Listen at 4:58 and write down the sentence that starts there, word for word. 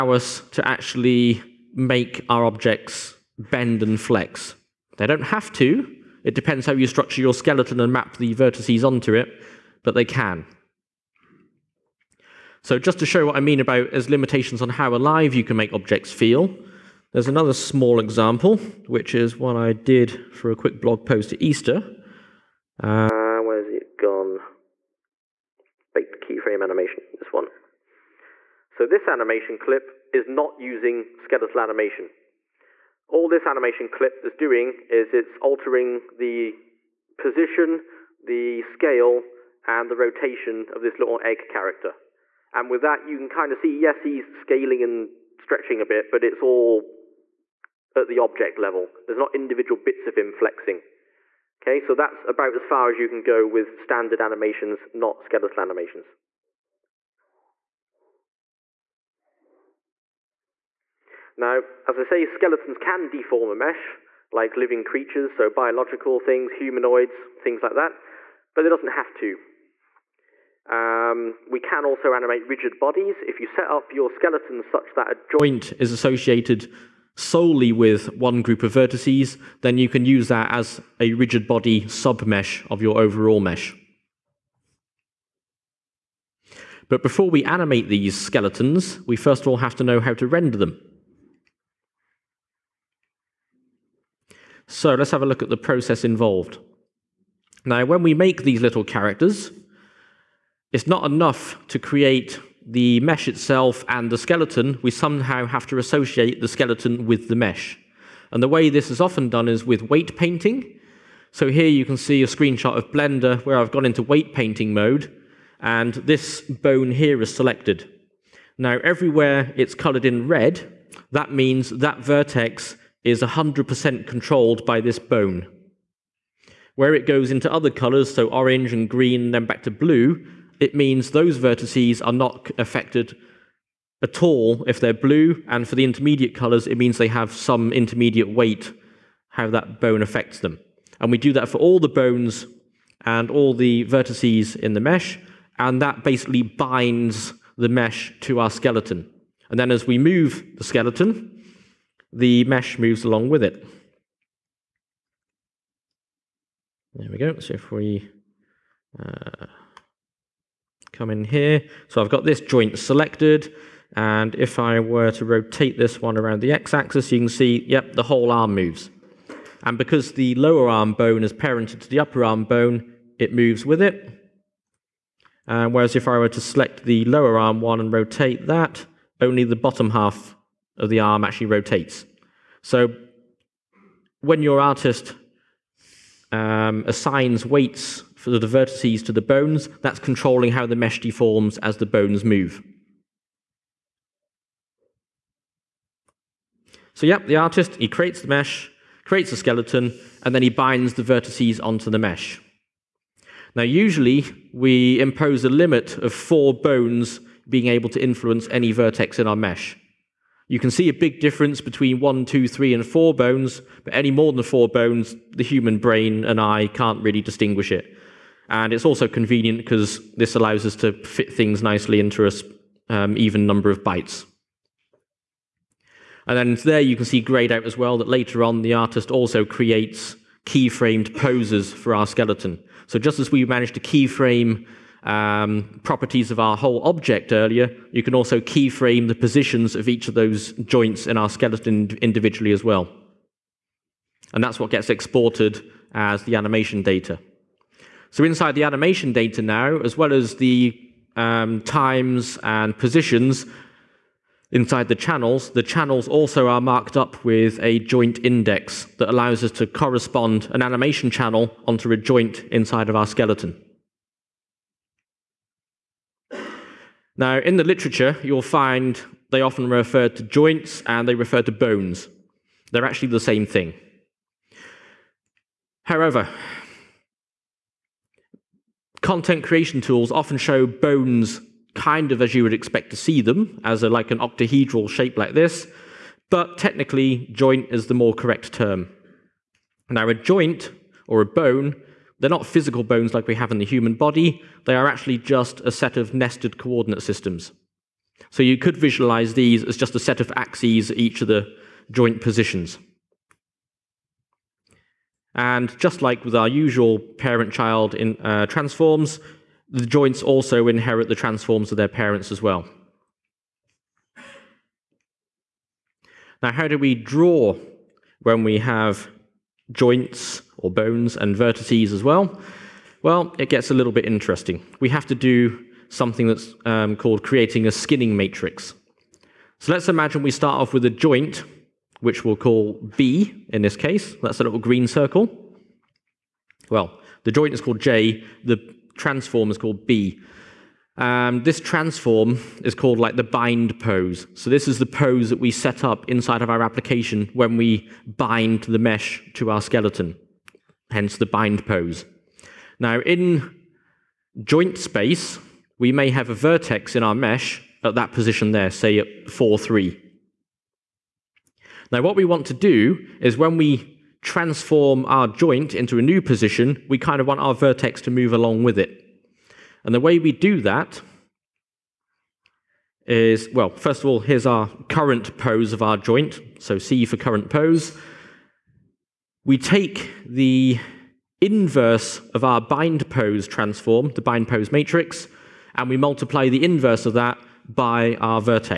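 So you could visualize these as just a set of axes at each of the joint positions.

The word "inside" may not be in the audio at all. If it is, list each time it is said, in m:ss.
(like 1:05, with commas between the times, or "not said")
4:08, 4:14, 4:22, 5:46.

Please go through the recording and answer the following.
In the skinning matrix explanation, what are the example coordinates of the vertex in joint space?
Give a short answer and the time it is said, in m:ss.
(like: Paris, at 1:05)
4, 3, at 5:59.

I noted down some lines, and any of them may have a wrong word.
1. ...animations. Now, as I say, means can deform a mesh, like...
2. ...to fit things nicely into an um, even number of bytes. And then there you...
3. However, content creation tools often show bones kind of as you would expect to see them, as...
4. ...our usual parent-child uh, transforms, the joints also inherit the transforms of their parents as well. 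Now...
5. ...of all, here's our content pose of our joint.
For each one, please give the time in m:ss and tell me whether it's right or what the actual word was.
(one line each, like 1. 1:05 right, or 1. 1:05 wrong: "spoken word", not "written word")
1. 0:55 wrong: "skeletons", not "means"
2. 3:40 right
3. 4:35 right
4. 5:06 right
5. 6:13 wrong: "current", not "content".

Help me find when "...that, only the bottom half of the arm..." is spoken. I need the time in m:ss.
2:58.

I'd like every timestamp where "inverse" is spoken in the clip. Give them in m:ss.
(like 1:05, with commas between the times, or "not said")
6:21, 6:26.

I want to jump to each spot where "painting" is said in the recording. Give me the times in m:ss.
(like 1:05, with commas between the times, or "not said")
1:50, 1:54.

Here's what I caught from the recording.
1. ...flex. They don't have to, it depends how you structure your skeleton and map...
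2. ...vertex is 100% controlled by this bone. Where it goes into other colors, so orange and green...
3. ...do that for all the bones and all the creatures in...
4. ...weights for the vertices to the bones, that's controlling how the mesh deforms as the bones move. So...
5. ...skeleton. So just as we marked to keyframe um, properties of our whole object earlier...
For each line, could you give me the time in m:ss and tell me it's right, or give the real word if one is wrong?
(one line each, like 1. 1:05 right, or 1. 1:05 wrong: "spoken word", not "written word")
1. 0:03 right
2. 2:01 right
3. 2:21 wrong: "vertices", not "creatures"
4. 3:07 right
5. 3:52 wrong: "managed", not "marked".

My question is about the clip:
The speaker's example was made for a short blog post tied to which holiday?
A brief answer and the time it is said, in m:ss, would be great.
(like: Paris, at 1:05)
Easter, at 0:21.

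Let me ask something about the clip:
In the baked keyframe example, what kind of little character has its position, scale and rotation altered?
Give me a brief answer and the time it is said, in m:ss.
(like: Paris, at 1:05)
Egg character, at 0:41.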